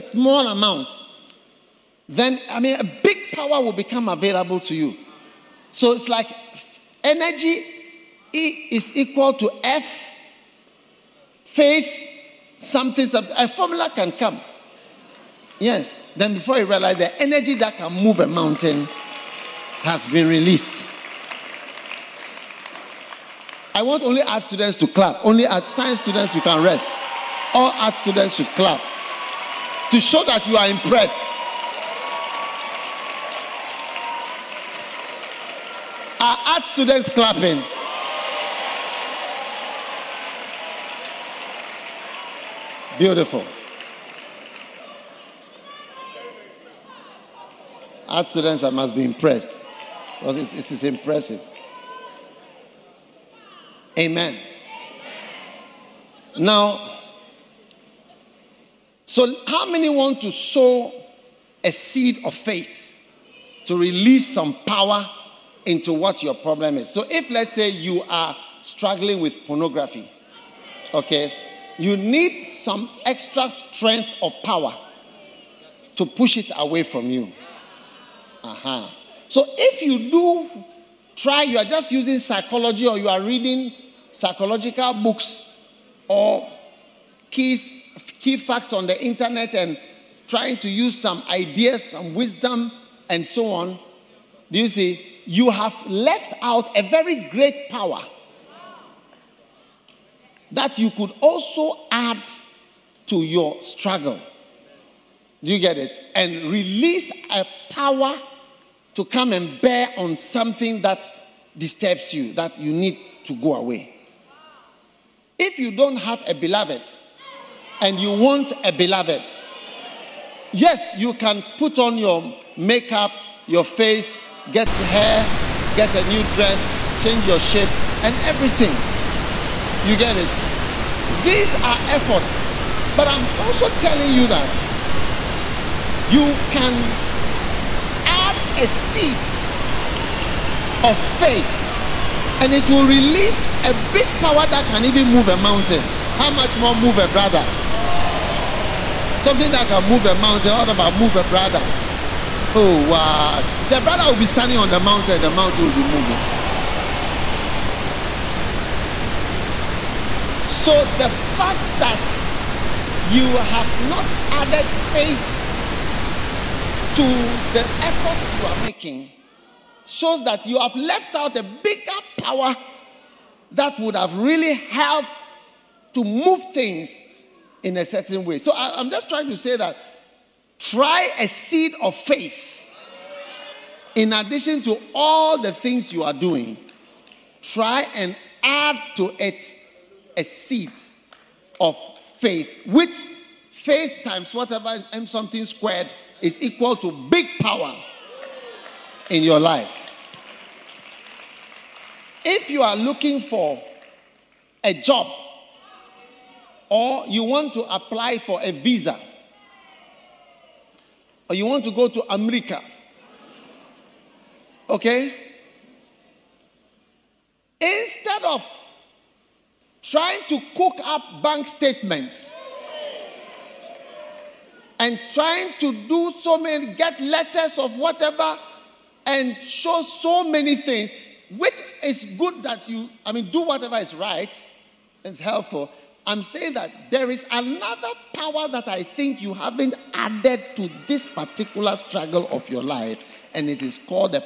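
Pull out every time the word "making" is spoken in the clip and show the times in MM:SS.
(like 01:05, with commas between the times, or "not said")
02:48.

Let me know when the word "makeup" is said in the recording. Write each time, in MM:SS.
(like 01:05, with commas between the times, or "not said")
02:02.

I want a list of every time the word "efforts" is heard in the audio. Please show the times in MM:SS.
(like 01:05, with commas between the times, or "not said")
02:11, 02:47.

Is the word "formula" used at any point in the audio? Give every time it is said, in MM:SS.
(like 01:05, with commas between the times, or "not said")
00:13.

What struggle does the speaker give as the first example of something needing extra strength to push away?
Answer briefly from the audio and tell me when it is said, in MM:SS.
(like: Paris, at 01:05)
Pornography, at 01:09.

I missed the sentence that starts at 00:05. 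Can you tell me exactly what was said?
So it's like energy E is equal to F, faith, something, something.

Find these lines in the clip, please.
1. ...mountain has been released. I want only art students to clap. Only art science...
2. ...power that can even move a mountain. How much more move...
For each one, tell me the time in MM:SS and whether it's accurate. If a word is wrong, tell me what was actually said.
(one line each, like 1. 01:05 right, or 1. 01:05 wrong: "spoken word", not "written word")
1. 00:18 right
2. 02:24 right.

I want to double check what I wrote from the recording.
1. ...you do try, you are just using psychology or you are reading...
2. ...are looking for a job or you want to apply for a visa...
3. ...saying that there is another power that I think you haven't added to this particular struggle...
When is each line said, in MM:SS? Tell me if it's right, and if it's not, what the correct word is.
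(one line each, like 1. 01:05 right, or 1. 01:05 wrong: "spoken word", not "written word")
1. 01:19 right
2. 03:22 right
3. 03:56 right.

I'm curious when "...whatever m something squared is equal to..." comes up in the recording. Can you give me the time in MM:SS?
03:14.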